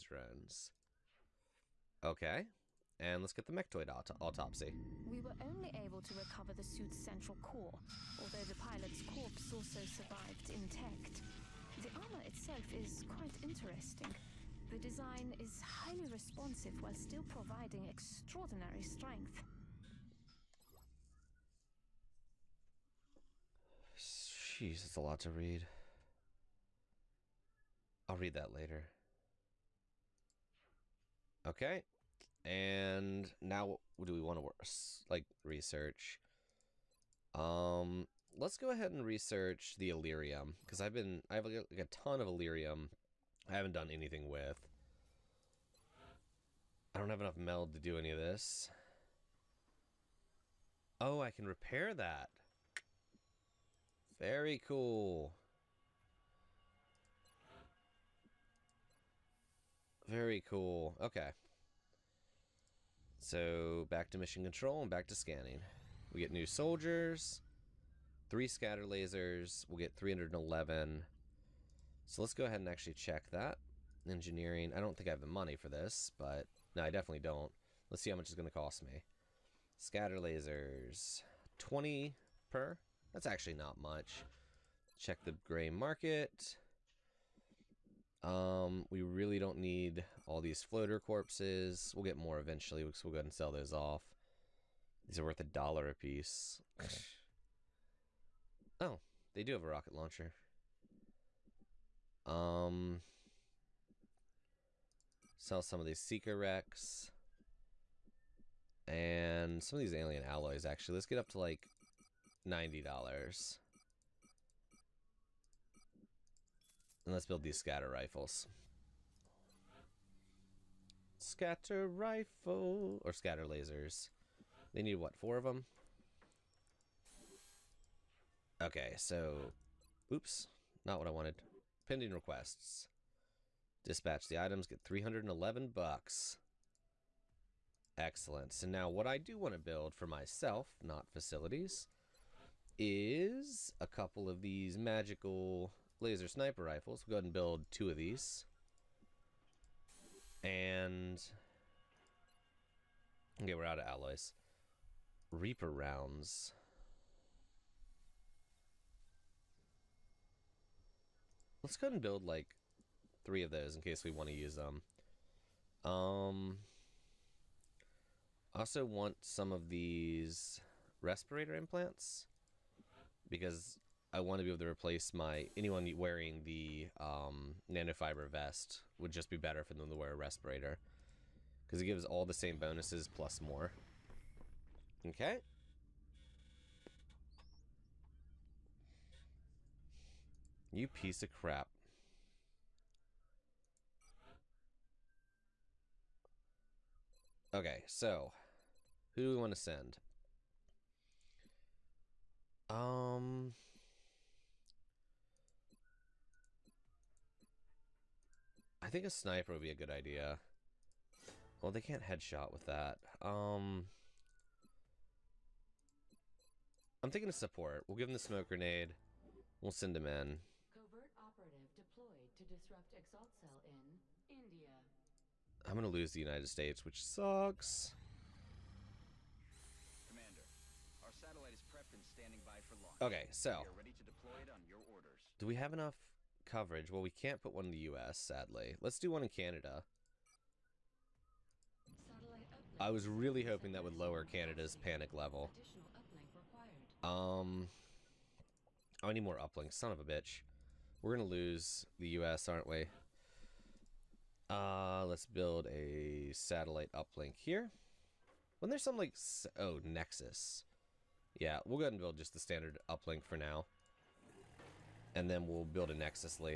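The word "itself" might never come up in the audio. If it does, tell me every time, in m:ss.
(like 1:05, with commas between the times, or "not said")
0:12.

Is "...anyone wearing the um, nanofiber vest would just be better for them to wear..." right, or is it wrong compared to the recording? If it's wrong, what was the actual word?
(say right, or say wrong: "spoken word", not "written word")
right.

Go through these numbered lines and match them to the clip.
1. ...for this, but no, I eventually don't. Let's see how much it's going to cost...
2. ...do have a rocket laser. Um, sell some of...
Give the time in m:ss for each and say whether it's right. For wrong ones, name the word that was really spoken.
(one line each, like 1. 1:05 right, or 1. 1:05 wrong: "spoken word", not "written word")
1. 1:15 wrong: "definitely", not "eventually"
2. 1:39 wrong: "launcher", not "laser".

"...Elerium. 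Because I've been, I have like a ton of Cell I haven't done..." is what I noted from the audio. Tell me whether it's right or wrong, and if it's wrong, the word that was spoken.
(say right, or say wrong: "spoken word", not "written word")
wrong: "Elerium", not "Cell".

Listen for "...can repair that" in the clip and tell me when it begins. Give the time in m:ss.
0:51.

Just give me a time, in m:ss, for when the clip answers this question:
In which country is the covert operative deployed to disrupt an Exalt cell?
3:44.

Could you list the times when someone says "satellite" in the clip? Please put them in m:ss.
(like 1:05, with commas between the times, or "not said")
3:51, 4:16.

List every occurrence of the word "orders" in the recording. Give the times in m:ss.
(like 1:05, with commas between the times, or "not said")
3:54.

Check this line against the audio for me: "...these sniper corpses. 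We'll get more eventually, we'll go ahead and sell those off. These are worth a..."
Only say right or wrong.
wrong.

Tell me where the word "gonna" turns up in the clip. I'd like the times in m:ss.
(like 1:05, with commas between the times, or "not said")
3:45, 4:11.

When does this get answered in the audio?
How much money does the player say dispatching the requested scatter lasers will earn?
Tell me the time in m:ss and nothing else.
2:14.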